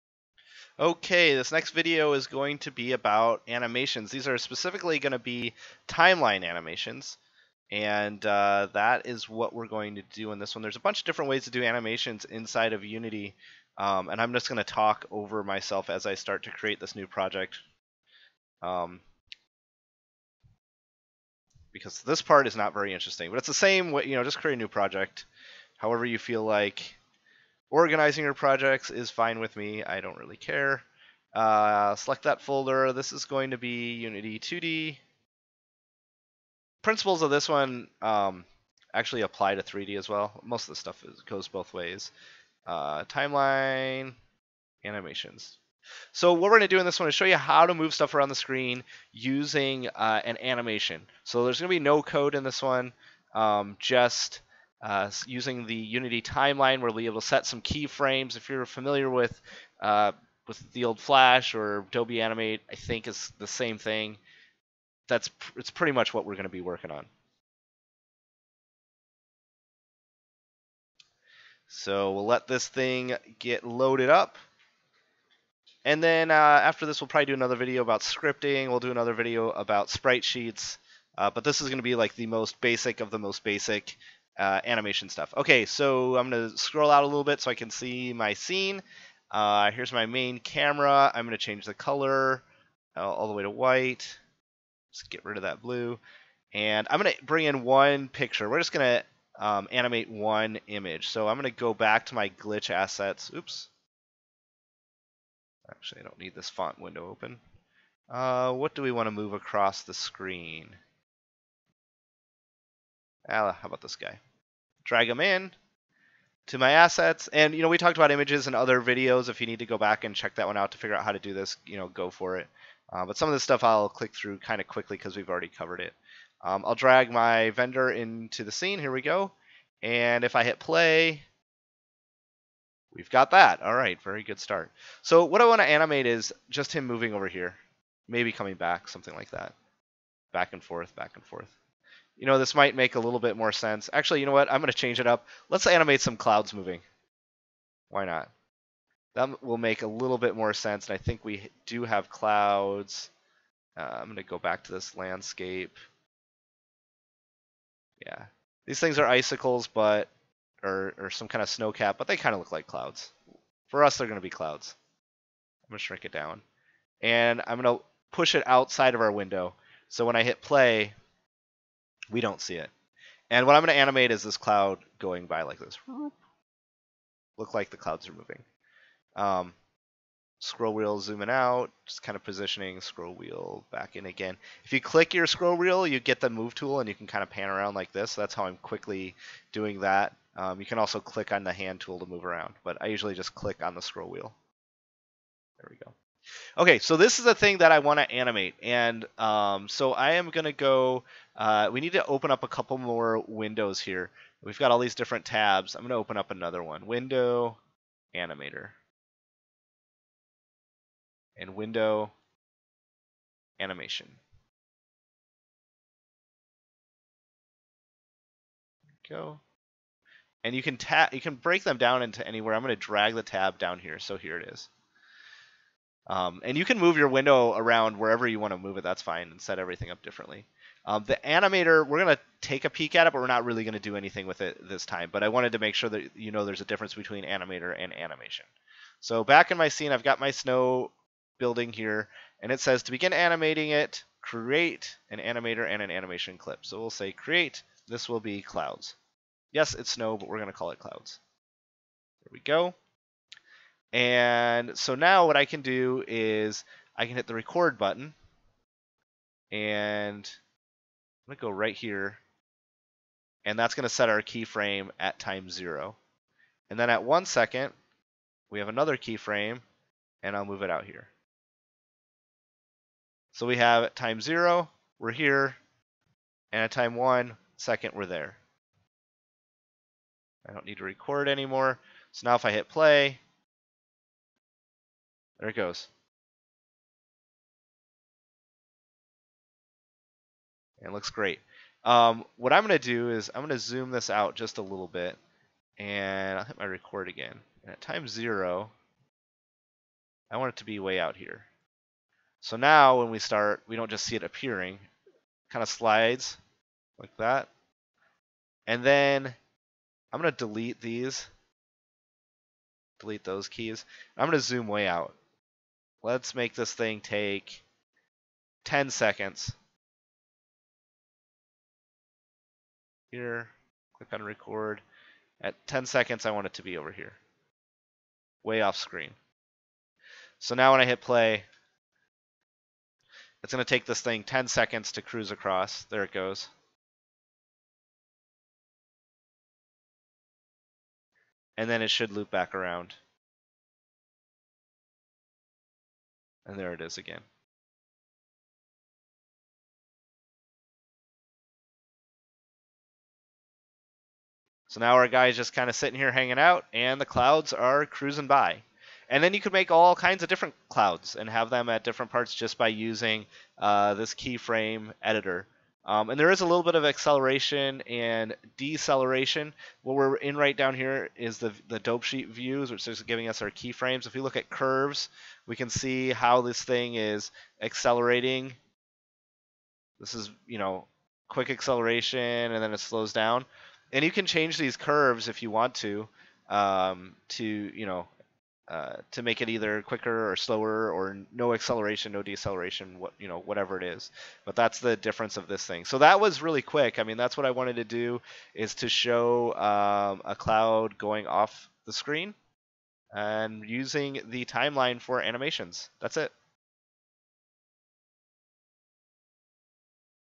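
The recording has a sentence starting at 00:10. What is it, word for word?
There's a bunch of different ways to do animations inside of Unity.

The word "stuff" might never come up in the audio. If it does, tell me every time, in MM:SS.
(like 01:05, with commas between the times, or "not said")
00:40, 00:47, 01:25, 02:03.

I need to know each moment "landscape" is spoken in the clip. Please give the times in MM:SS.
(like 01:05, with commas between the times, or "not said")
02:34.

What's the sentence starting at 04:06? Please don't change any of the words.
So we'll say create, this will be clouds.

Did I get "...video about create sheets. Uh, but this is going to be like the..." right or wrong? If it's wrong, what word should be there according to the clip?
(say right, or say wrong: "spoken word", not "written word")
wrong: "sprite", not "create".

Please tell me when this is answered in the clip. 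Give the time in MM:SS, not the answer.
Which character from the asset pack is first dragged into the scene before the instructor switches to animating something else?
02:07.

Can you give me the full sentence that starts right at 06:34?
But that's the difference of this thing.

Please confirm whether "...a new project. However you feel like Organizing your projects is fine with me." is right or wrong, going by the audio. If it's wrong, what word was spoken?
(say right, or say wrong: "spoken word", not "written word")
right.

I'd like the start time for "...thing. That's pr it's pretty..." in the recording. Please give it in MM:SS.
01:03.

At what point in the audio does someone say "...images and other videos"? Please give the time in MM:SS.
01:58.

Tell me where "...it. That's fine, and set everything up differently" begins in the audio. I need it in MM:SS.
03:48.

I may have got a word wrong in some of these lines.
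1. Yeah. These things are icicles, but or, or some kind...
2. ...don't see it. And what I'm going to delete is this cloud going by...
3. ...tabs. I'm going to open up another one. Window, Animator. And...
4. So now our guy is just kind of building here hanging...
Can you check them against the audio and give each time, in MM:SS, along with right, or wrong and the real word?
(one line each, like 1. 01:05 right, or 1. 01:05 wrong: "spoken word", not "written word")
1. 02:38 right
2. 02:52 wrong: "animate", not "delete"
3. 03:25 right
4. 05:54 wrong: "sitting", not "building".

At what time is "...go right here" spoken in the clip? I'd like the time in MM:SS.
04:21.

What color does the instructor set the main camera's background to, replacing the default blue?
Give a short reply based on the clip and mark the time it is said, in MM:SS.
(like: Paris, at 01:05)
White, at 01:33.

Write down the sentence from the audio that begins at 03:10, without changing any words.
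Um, you can also click on the hand tool to move around, but I usually just click on the scroll wheel.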